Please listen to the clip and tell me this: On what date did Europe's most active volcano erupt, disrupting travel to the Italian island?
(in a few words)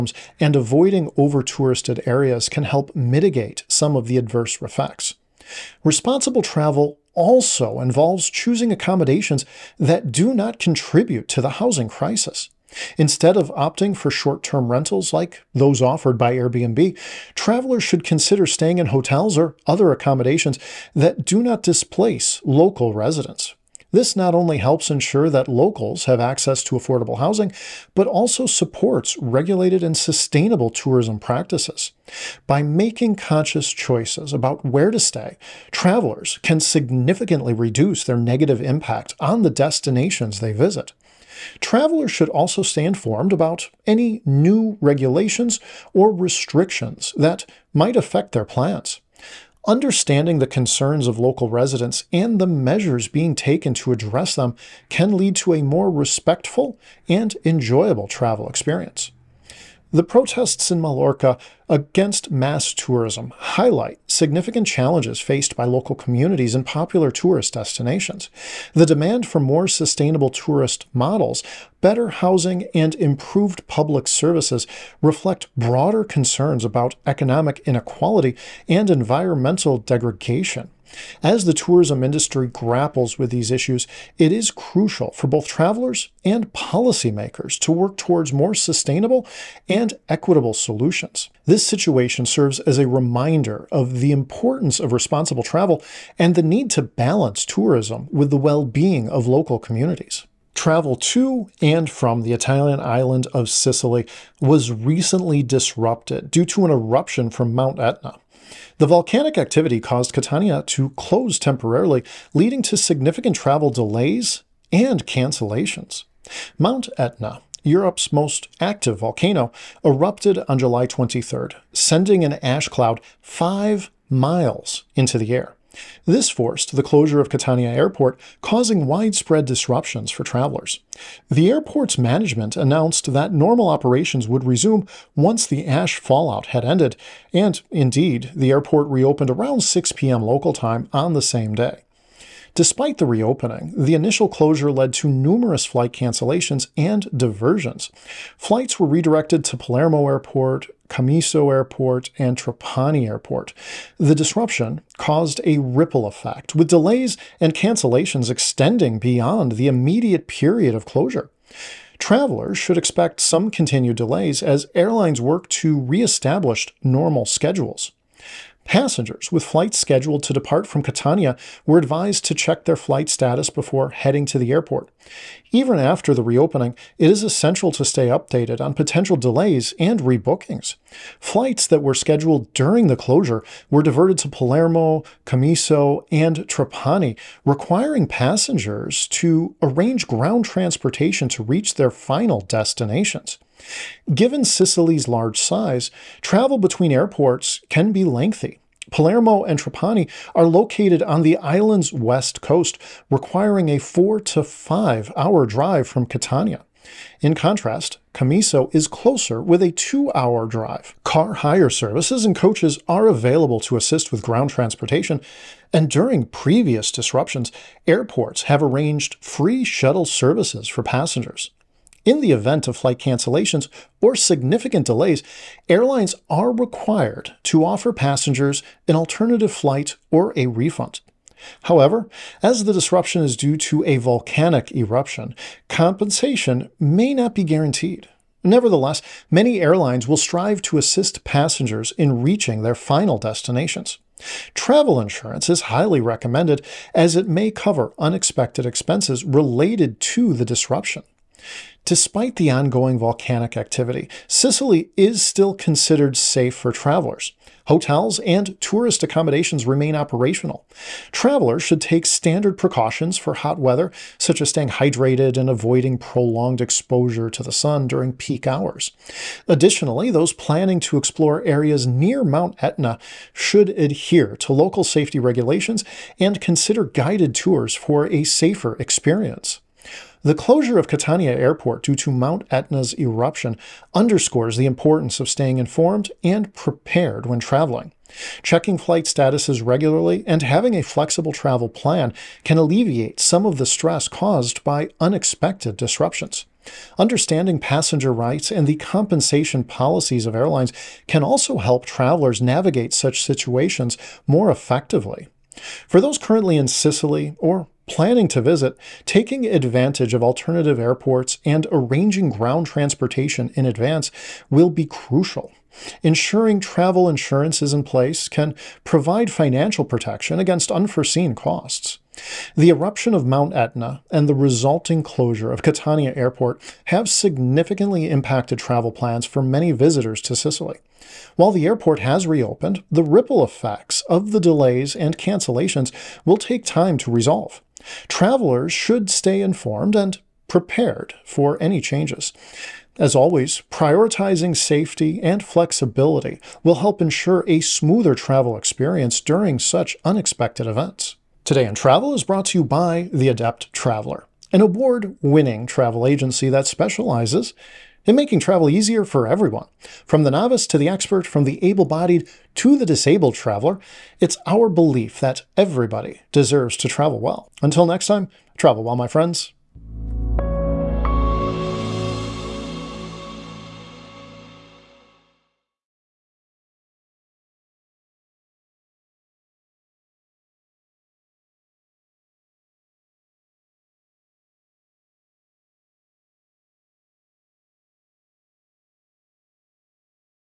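July 23.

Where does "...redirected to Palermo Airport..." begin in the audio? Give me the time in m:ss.
2:28.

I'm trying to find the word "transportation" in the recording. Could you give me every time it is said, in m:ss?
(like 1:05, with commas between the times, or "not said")
3:10, 3:34, 5:12.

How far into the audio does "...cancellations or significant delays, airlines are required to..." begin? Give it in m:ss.
3:42.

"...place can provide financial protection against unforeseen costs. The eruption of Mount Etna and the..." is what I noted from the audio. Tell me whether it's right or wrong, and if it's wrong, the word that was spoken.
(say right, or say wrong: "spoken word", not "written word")
right.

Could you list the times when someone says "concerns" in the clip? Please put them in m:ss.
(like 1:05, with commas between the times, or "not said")
0:50, 1:16.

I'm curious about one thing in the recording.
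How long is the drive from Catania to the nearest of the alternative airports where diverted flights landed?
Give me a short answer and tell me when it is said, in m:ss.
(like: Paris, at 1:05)
2 hours, at 3:29.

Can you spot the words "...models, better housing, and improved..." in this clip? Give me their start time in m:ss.
1:10.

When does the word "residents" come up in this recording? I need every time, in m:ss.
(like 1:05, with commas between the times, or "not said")
0:22, 0:51.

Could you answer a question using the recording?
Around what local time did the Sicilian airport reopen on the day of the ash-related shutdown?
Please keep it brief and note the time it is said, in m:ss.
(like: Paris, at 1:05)
6 p.m., at 2:19.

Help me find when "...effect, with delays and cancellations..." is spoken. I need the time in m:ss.
2:36.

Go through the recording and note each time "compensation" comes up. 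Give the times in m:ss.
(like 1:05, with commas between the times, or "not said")
3:55, 4:58.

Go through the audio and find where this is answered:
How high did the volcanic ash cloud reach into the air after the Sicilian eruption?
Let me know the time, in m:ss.
2:03.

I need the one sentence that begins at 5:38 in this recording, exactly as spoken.
Travelers should stay informed and prepared for any changes.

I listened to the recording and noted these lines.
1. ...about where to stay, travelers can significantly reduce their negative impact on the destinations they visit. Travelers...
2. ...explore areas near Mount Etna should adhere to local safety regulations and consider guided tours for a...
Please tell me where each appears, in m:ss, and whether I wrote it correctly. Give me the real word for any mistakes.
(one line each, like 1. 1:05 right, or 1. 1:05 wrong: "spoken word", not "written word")
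1. 0:34 right
2. 4:30 right.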